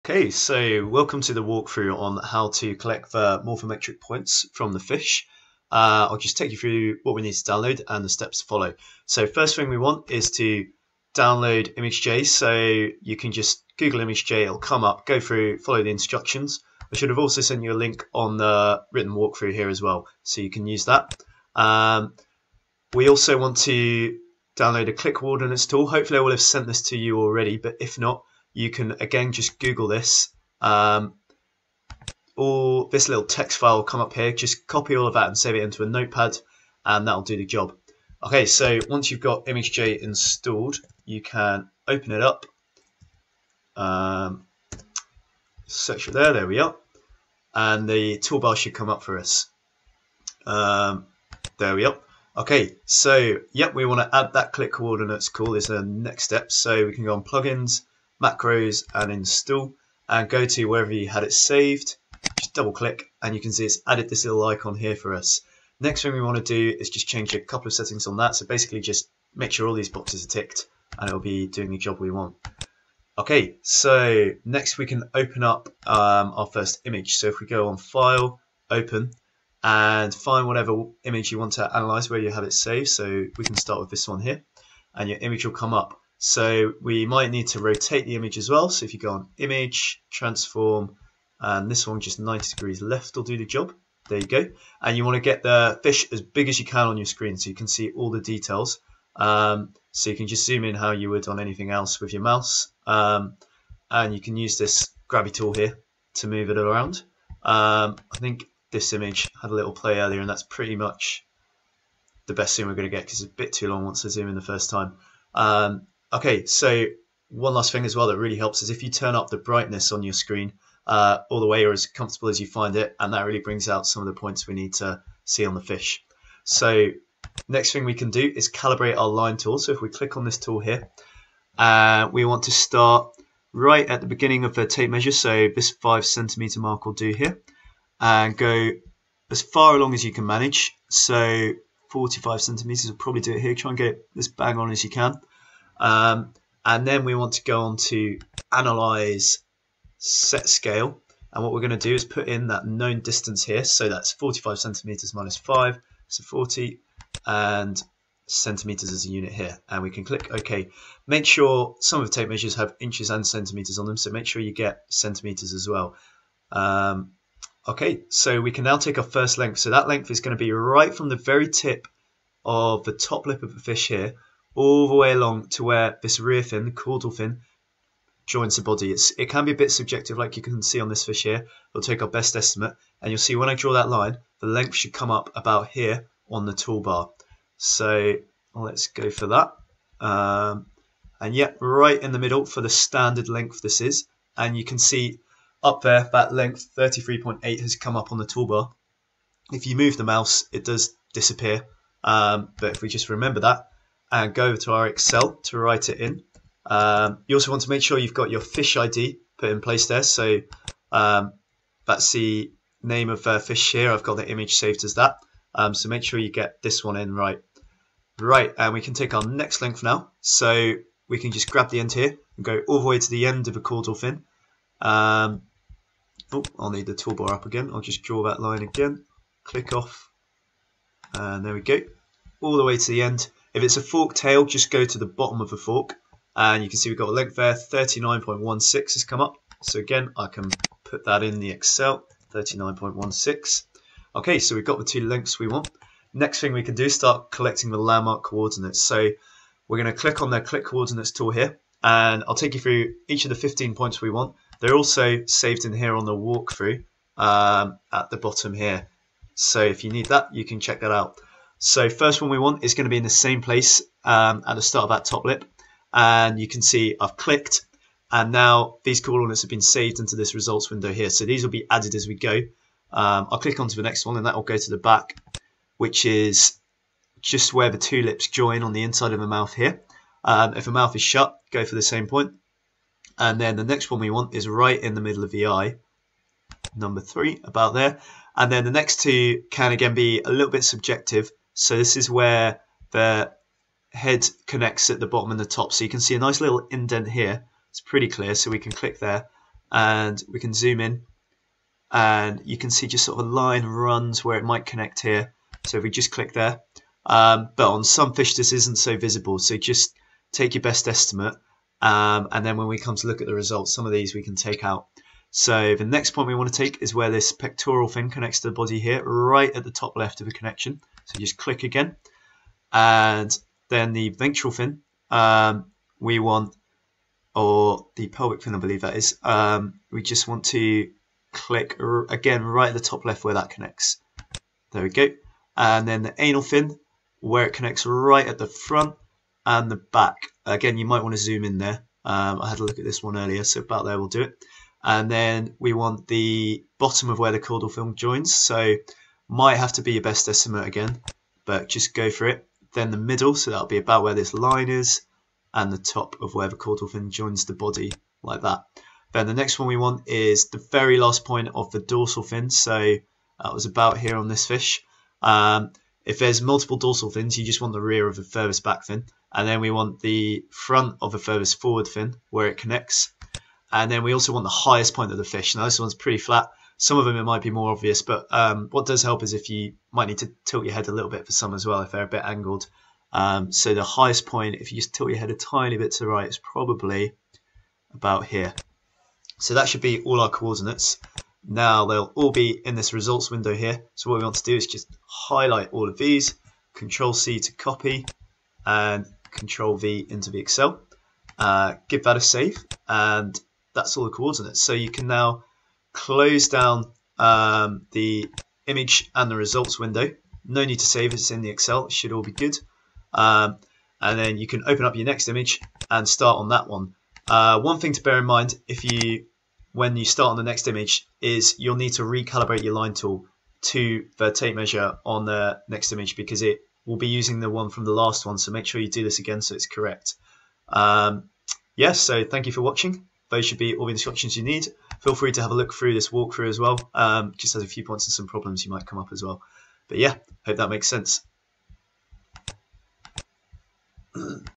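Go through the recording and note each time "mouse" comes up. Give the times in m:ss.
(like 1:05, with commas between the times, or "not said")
1:42, 3:20.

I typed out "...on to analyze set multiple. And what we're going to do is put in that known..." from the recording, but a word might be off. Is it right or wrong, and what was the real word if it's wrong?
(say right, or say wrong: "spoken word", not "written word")
wrong: "scale", not "multiple".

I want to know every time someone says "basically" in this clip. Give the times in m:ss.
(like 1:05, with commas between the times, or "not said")
1:08.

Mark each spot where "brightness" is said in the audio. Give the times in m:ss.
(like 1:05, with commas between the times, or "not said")
1:59.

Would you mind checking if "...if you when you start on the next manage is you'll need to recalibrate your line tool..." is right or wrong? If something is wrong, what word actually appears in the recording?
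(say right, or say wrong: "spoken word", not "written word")
wrong: "image", not "manage".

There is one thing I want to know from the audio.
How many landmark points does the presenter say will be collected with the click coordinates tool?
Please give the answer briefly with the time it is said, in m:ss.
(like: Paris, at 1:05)
15, at 4:13.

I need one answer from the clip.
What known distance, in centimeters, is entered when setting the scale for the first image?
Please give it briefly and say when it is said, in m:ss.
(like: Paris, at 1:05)
40, at 2:36.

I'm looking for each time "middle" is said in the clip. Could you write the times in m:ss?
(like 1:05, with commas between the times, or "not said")
3:12, 4:45, 5:52.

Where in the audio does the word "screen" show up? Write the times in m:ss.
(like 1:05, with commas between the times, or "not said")
1:37, 2:00.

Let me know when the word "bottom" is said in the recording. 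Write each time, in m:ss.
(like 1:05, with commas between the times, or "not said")
3:55, 4:18, 4:55, 5:46.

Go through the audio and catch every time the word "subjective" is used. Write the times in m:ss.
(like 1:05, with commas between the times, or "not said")
2:59, 4:50.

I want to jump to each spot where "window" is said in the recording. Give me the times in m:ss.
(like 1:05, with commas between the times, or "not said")
4:30, 6:33, 6:49.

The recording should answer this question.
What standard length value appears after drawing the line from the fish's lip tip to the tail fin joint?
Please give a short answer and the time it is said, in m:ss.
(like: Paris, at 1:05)
33.8, at 3:16.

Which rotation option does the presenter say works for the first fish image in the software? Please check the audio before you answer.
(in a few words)
90 degrees left.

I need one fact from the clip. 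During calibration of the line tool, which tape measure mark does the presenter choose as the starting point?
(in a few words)
5 centimeters.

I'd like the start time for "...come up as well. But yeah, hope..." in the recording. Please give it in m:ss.
7:18.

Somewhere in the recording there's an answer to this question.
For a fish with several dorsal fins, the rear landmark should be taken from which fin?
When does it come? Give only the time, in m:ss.
6:08.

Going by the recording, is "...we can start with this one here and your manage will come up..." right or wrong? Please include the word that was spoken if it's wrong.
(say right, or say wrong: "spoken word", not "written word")
wrong: "image", not "manage".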